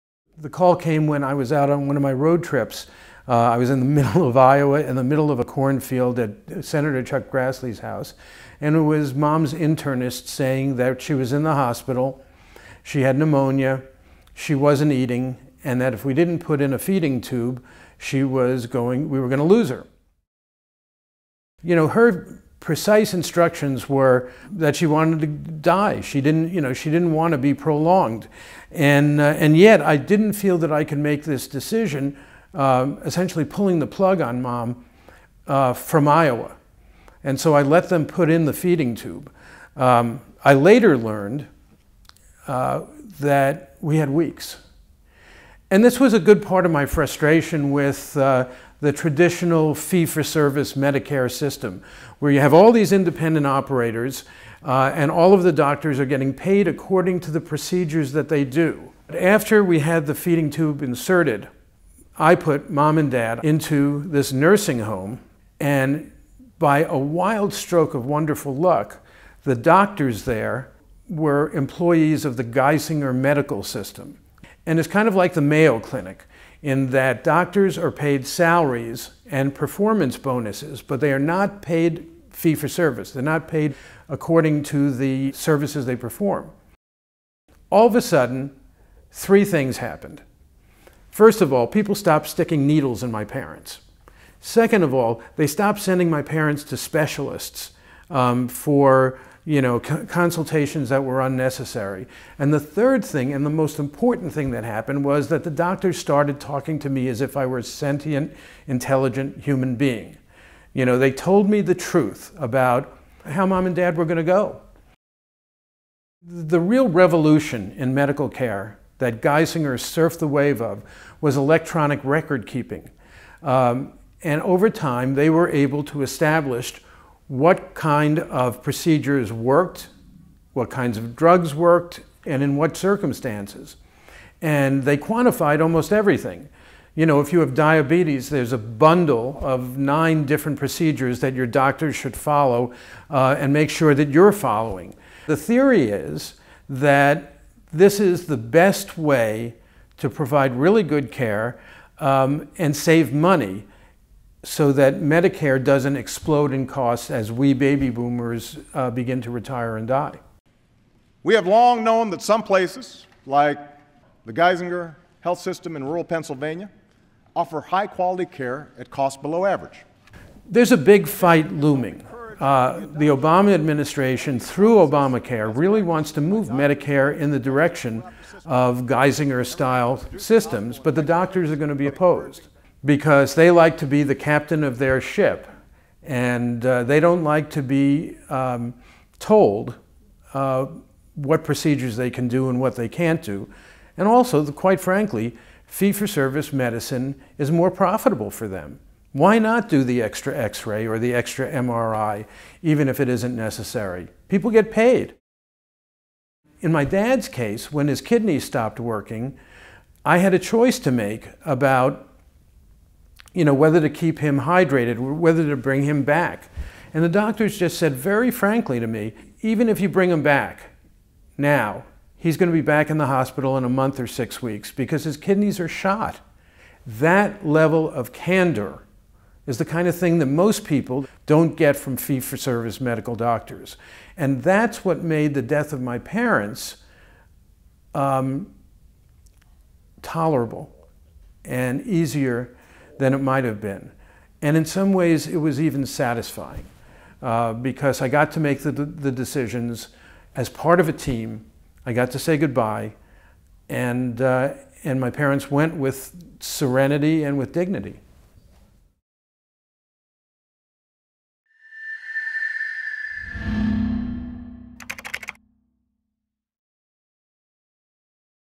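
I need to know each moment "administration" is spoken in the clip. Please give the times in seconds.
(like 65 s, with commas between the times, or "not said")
173 s.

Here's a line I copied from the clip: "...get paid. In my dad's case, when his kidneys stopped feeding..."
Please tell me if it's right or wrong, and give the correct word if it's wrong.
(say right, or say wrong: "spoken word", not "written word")
wrong: "working", not "feeding".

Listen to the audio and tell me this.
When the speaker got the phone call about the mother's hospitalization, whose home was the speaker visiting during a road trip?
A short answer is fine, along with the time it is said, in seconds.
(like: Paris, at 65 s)
Chuck Grassley, at 7 s.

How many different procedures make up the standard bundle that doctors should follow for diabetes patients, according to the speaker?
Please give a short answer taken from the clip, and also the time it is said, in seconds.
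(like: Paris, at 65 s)
9, at 139 s.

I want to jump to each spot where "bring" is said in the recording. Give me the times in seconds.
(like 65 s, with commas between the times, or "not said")
215 s, 219 s.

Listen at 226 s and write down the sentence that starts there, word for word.
That level of candor is the kind of thing that most people don't get from fee for service medical doctors.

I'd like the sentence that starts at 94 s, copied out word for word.
Second of all, they stopped sending my parents to specialists um, for you know, consultations that were unnecessary.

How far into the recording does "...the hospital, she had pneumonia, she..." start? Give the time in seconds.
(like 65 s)
11 s.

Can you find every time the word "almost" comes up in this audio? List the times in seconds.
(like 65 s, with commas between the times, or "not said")
135 s.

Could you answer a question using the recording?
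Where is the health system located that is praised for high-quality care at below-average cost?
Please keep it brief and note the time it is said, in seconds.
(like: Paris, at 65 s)
rural Pennsylvania, at 165 s.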